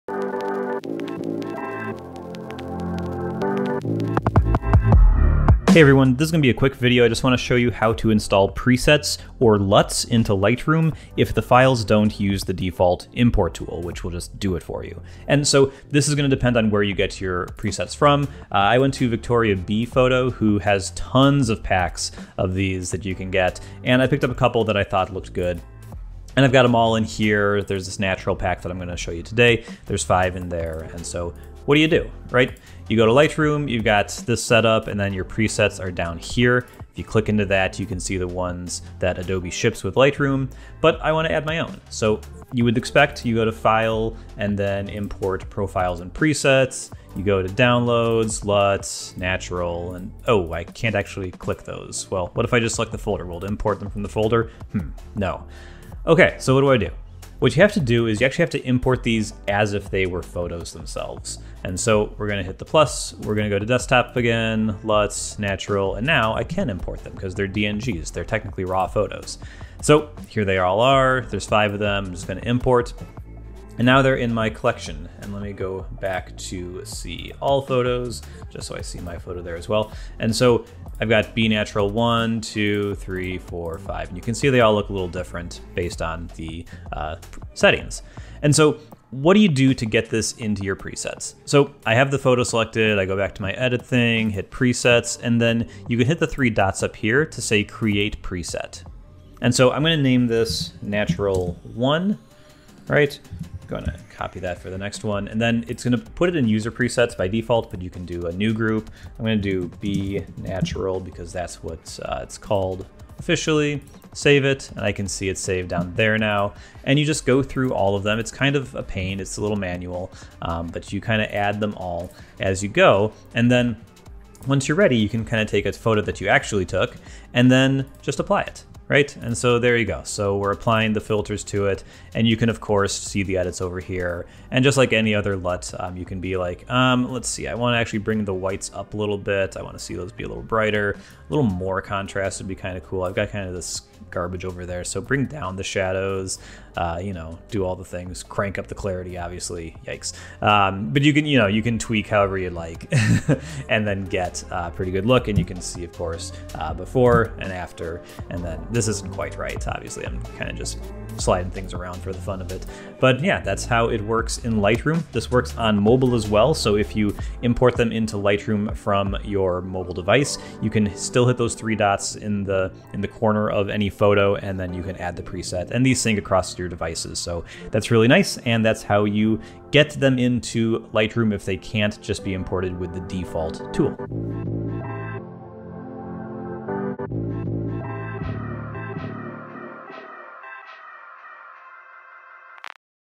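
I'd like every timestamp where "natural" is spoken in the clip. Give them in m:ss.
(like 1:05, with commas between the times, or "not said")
0:27, 0:49, 1:05, 1:21, 1:40, 1:50.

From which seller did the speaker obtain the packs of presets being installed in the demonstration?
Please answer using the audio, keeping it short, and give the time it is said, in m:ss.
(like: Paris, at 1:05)
Victoria Bee Photo, at 0:19.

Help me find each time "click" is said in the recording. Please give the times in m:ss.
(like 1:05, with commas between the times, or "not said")
0:37, 0:51.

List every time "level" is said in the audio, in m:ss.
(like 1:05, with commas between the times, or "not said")
not said.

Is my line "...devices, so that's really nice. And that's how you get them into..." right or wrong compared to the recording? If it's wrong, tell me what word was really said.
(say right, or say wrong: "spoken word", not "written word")
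right.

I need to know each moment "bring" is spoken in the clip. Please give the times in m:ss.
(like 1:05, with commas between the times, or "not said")
2:17, 2:24.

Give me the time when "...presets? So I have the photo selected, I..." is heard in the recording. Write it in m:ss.
1:30.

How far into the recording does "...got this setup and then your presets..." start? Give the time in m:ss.
0:33.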